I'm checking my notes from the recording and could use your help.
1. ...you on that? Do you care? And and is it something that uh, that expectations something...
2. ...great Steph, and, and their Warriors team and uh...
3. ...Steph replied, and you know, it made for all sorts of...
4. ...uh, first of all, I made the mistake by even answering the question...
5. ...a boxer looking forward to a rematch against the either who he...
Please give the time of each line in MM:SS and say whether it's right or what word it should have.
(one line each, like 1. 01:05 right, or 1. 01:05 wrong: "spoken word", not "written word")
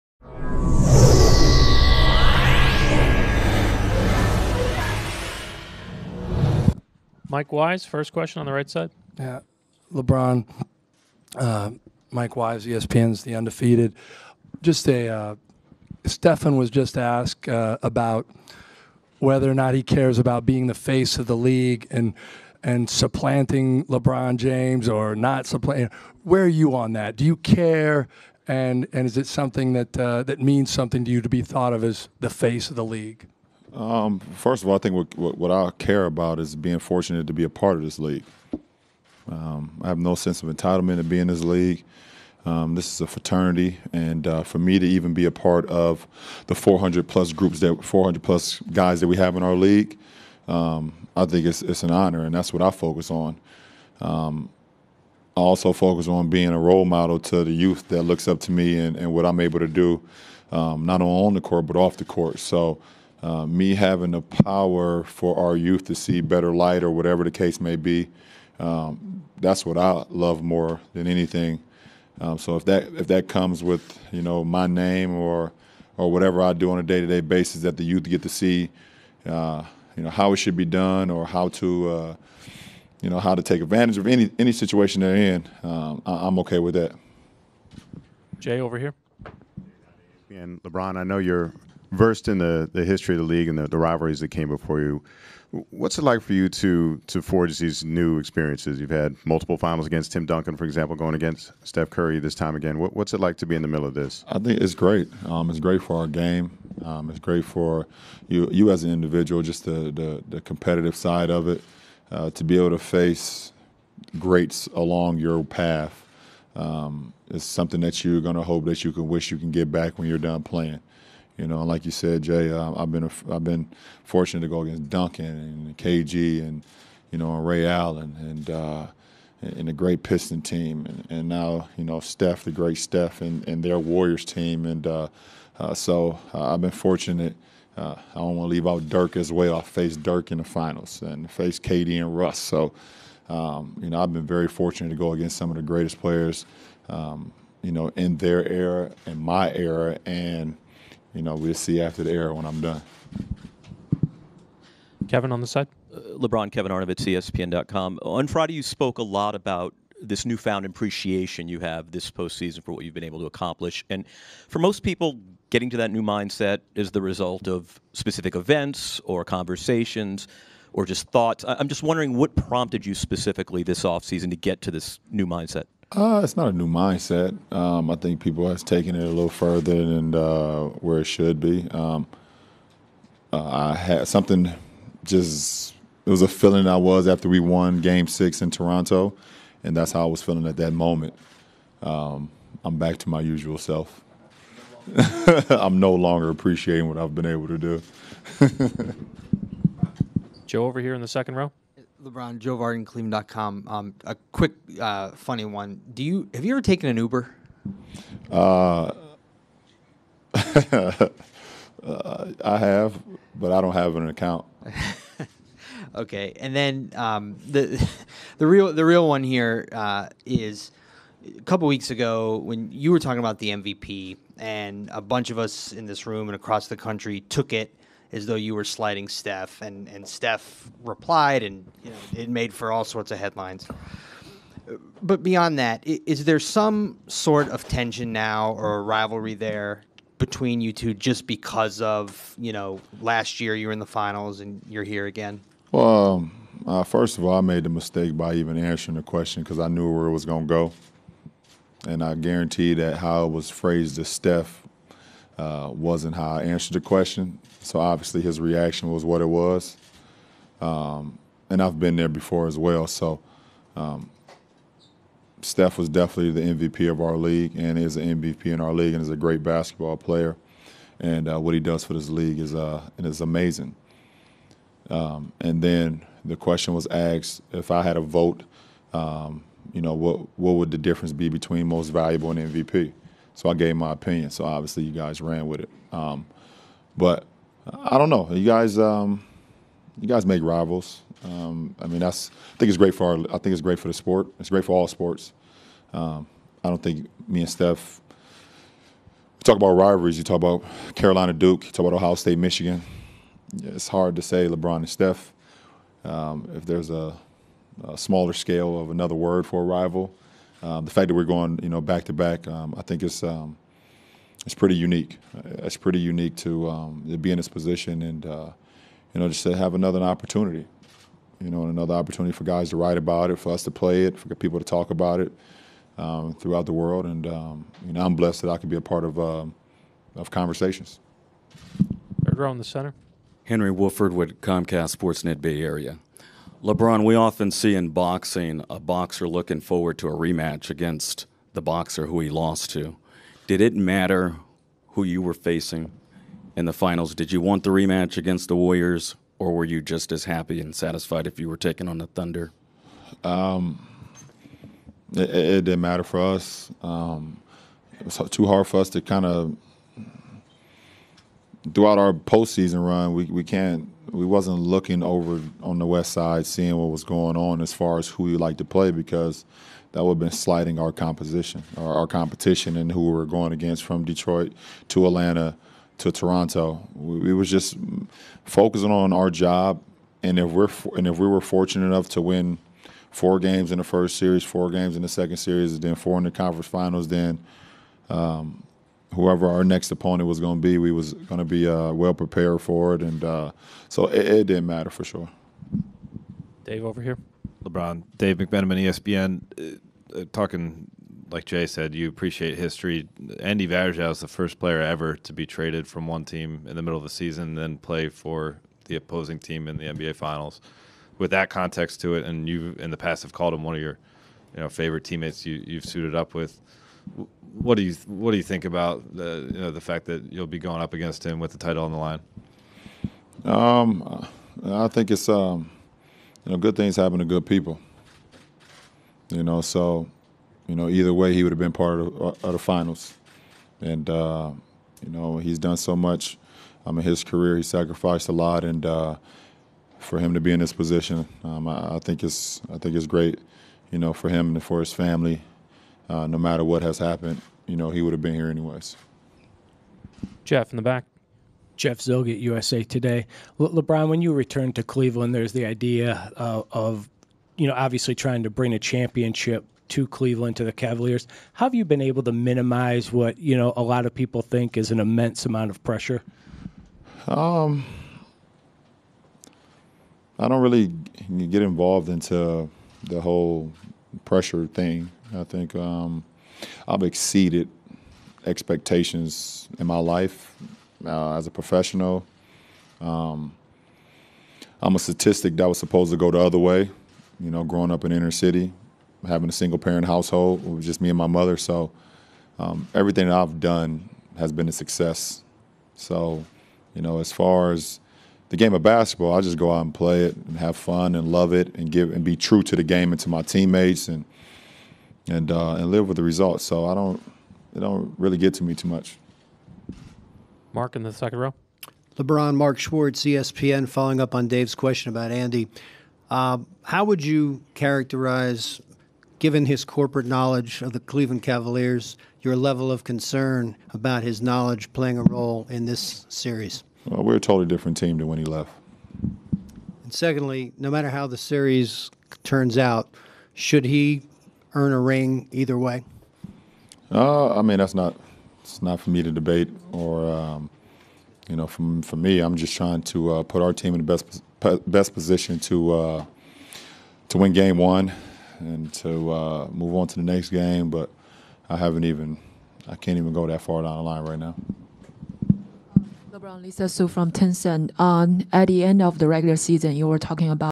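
1. 00:26 wrong: "means", not "expectations"
2. 02:12 right
3. 03:50 right
4. 04:06 right
5. 05:38 wrong: "boxer", not "either".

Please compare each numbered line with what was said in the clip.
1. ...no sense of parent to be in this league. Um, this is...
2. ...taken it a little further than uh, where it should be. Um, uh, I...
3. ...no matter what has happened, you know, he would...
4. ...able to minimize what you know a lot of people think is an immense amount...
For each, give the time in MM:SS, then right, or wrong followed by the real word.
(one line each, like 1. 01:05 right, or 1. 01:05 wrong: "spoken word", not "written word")
1. 00:39 wrong: "entitlement", not "parent"
2. 02:58 right
3. 07:26 right
4. 07:42 right.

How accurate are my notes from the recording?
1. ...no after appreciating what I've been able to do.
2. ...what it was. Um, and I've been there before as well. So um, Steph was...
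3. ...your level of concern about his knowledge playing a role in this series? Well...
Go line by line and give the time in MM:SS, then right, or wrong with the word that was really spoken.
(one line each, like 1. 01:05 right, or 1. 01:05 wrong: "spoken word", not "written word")
1. 03:15 wrong: "longer", not "after"
2. 04:19 right
3. 08:42 right.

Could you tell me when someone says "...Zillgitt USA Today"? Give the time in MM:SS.
07:31.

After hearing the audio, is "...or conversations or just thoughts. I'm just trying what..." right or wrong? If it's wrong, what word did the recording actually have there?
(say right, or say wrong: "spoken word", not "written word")
wrong: "wondering", not "trying".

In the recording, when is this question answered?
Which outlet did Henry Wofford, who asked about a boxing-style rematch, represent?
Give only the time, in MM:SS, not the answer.
05:34.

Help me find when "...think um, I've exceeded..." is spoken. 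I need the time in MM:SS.
07:55.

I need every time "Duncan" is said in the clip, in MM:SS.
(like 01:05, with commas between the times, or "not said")
01:40, 02:04.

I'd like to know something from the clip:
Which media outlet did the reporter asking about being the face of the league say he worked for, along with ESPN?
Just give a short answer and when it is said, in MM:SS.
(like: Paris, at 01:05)
The Undefeated, at 00:13.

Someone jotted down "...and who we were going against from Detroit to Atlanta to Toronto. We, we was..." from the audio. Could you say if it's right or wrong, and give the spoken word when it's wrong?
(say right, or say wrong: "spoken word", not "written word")
right.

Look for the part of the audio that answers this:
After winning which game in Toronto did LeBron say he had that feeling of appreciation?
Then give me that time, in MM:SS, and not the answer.
03:07.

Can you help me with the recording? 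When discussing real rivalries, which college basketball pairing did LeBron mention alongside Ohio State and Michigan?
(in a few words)
Carolina Duke.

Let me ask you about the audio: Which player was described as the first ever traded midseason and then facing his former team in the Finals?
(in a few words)
Andy Varejao.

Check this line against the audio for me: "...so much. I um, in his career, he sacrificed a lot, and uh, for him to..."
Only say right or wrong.
right.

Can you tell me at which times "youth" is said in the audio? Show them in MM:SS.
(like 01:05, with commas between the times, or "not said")
00:57, 01:05, 01:17.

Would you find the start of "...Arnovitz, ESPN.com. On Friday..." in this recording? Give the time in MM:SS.
02:36.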